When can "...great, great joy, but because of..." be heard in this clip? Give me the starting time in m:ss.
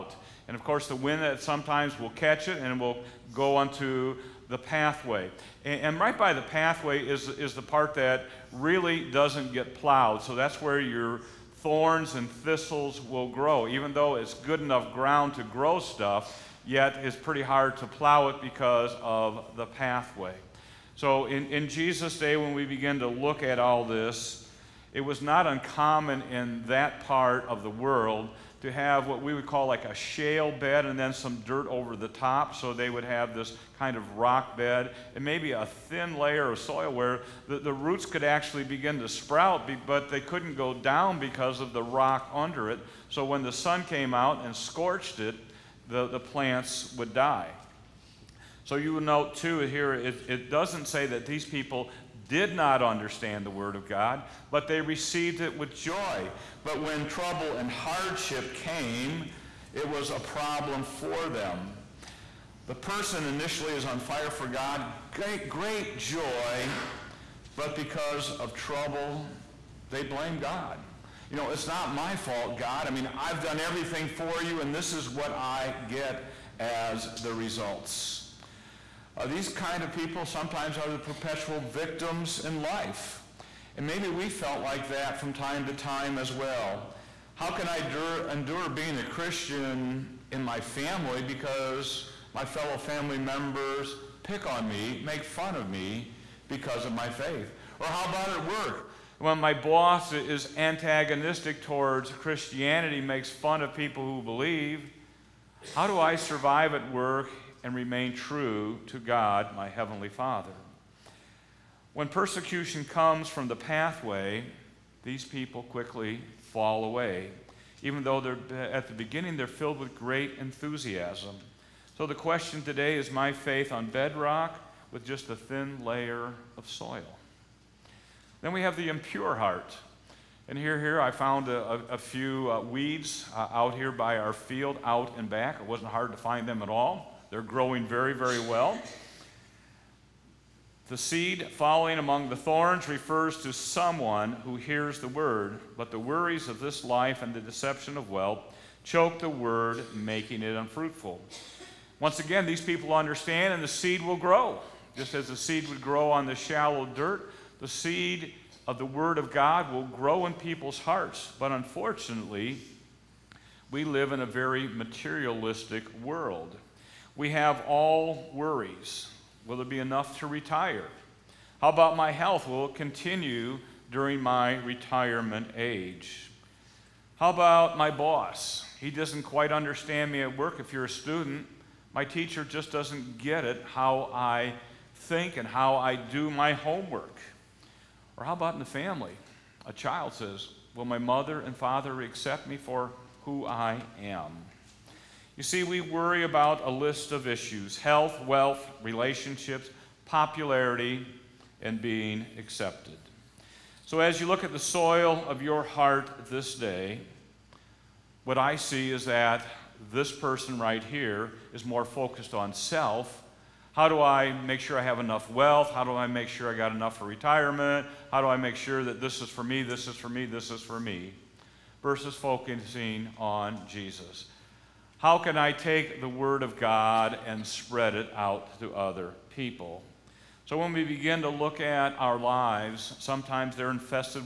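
1:05.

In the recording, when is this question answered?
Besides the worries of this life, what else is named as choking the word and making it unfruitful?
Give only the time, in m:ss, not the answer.
2:27.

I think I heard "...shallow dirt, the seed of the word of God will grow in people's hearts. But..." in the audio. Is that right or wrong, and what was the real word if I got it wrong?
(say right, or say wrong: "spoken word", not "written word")
right.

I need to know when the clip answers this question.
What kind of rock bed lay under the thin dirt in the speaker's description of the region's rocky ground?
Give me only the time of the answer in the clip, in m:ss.
0:29.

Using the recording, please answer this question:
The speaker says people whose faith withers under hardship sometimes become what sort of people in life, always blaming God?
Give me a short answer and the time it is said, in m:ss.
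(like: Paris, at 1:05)
Perpetual victims, at 1:20.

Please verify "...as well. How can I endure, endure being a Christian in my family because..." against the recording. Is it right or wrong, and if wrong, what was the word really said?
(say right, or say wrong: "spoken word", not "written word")
right.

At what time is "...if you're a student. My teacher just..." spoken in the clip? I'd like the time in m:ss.
3:00.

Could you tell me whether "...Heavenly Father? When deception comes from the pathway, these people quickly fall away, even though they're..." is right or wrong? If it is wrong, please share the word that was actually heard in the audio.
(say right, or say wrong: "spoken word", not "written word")
wrong: "persecution", not "deception".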